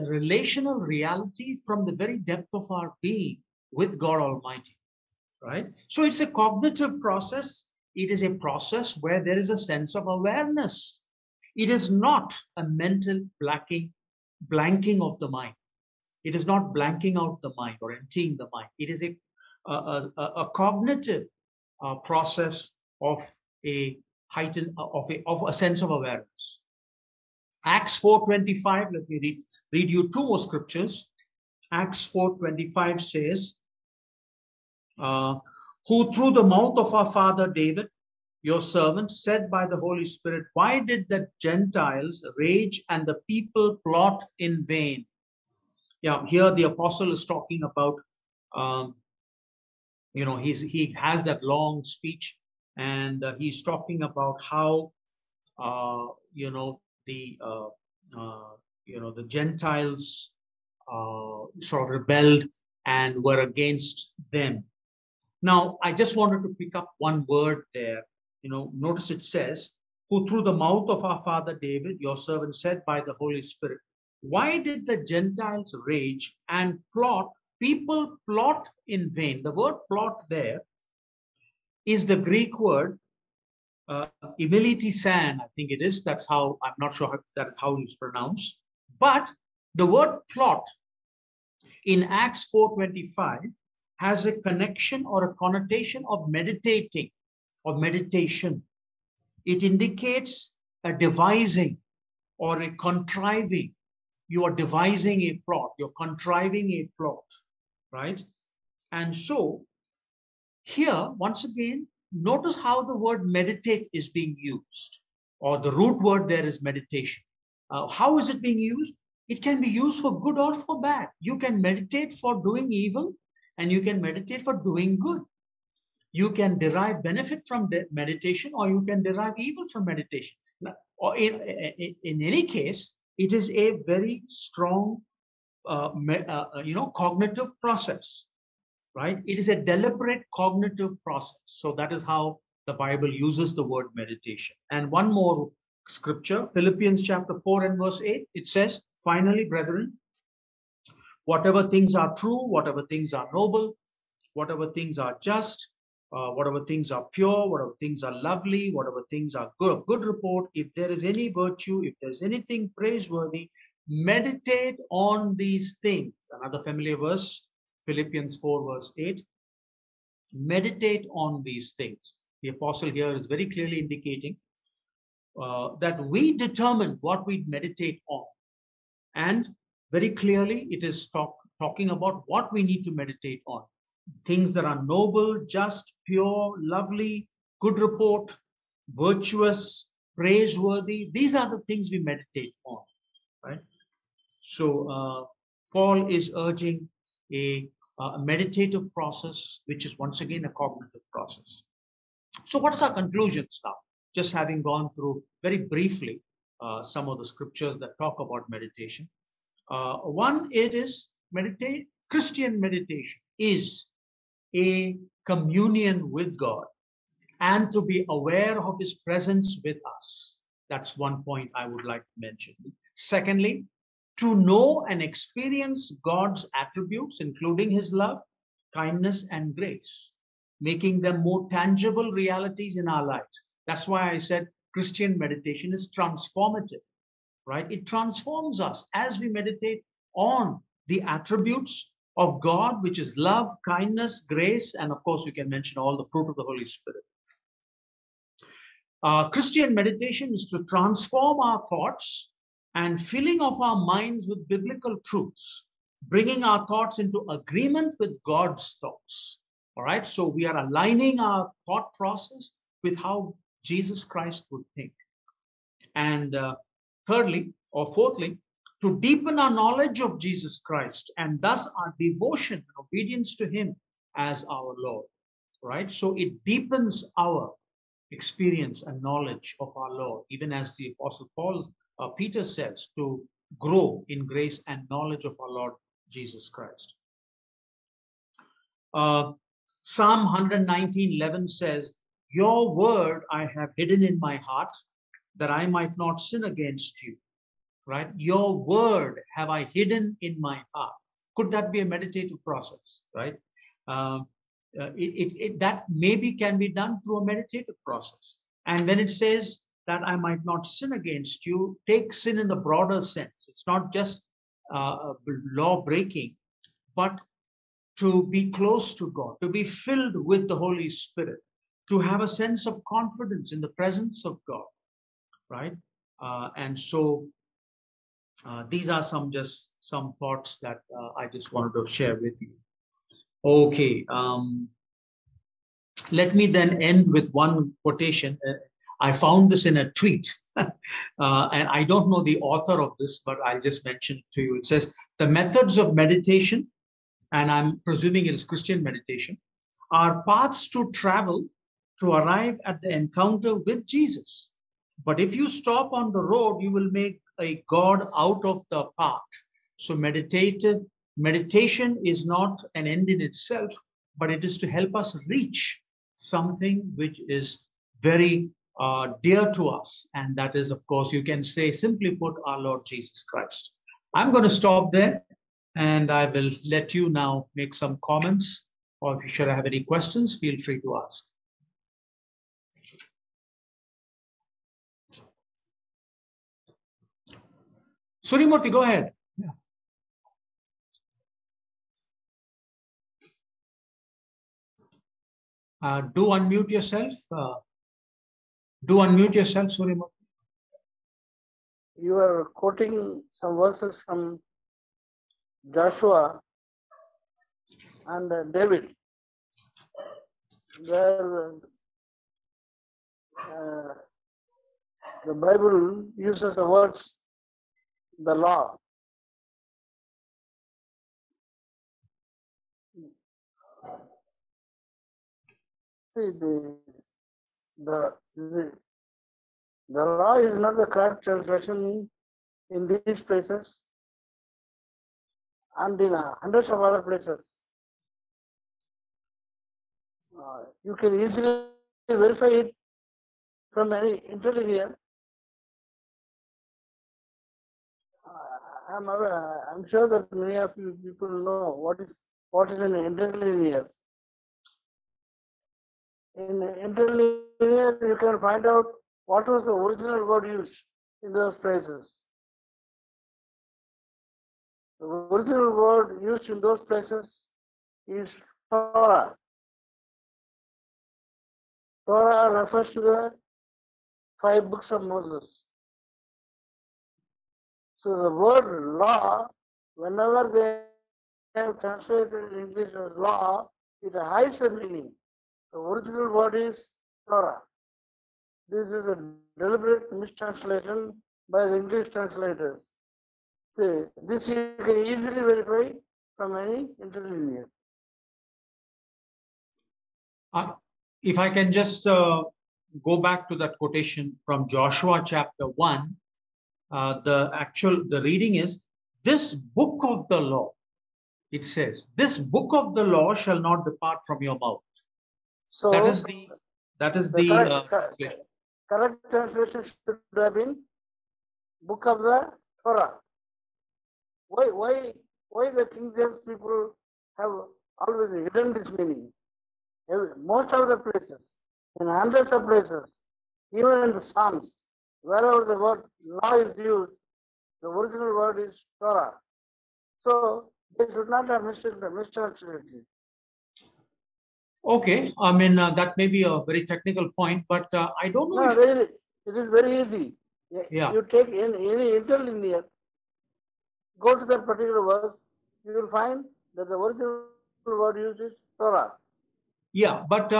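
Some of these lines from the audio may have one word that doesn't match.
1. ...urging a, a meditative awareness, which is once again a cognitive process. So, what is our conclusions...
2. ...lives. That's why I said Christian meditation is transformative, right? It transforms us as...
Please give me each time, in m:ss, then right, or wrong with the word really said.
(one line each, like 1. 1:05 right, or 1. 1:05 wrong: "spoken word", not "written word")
1. 3:16 wrong: "process", not "awareness"
2. 3:53 right.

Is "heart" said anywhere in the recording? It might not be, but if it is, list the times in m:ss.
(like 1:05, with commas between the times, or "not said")
4:54, 5:00.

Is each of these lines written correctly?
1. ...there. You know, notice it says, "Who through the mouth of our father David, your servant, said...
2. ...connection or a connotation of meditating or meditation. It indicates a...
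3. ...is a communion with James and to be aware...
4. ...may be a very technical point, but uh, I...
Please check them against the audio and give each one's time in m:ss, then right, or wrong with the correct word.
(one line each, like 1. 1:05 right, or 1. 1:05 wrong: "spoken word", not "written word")
1. 1:07 right
2. 1:34 right
3. 3:33 wrong: "God", not "James"
4. 9:06 right.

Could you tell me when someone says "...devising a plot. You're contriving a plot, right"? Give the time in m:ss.
1:44.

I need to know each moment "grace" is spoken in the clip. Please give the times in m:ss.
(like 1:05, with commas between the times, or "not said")
3:49, 4:04, 4:44.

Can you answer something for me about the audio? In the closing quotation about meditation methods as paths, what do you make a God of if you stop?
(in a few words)
the path.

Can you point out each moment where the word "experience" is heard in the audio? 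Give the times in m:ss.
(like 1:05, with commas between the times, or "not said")
3:45, 4:38.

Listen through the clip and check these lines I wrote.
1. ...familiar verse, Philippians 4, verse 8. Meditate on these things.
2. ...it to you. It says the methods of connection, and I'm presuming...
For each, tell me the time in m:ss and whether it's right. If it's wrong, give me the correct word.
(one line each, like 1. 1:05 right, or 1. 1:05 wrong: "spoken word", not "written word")
1. 2:46 right
2. 5:44 wrong: "meditation", not "connection".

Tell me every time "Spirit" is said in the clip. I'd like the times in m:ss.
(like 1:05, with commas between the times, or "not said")
0:40, 1:13, 4:06, 5:20.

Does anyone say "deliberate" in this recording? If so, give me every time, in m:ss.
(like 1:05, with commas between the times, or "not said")
2:19, 8:09.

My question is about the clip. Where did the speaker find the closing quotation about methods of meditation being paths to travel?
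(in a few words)
a tweet.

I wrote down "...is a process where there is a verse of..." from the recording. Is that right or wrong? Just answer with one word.
wrong.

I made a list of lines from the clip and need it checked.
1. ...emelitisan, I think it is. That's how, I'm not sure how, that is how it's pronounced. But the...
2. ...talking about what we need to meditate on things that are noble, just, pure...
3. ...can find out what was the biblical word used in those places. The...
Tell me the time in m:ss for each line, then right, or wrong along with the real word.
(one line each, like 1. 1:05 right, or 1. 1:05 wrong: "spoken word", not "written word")
1. 1:24 right
2. 3:01 right
3. 7:38 wrong: "original", not "biblical".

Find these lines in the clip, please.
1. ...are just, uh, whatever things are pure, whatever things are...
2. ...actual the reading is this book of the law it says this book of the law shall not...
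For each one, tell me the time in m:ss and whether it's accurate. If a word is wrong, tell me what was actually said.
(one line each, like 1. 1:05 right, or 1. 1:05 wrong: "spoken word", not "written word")
1. 2:34 right
2. 8:27 right.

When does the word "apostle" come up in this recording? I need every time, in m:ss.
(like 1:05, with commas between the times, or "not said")
0:46, 2:52, 4:40.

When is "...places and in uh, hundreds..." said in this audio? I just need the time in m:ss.
7:13.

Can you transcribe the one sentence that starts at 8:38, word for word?
correct translation should have been book of the Torah.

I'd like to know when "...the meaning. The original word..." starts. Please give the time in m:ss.
8:04.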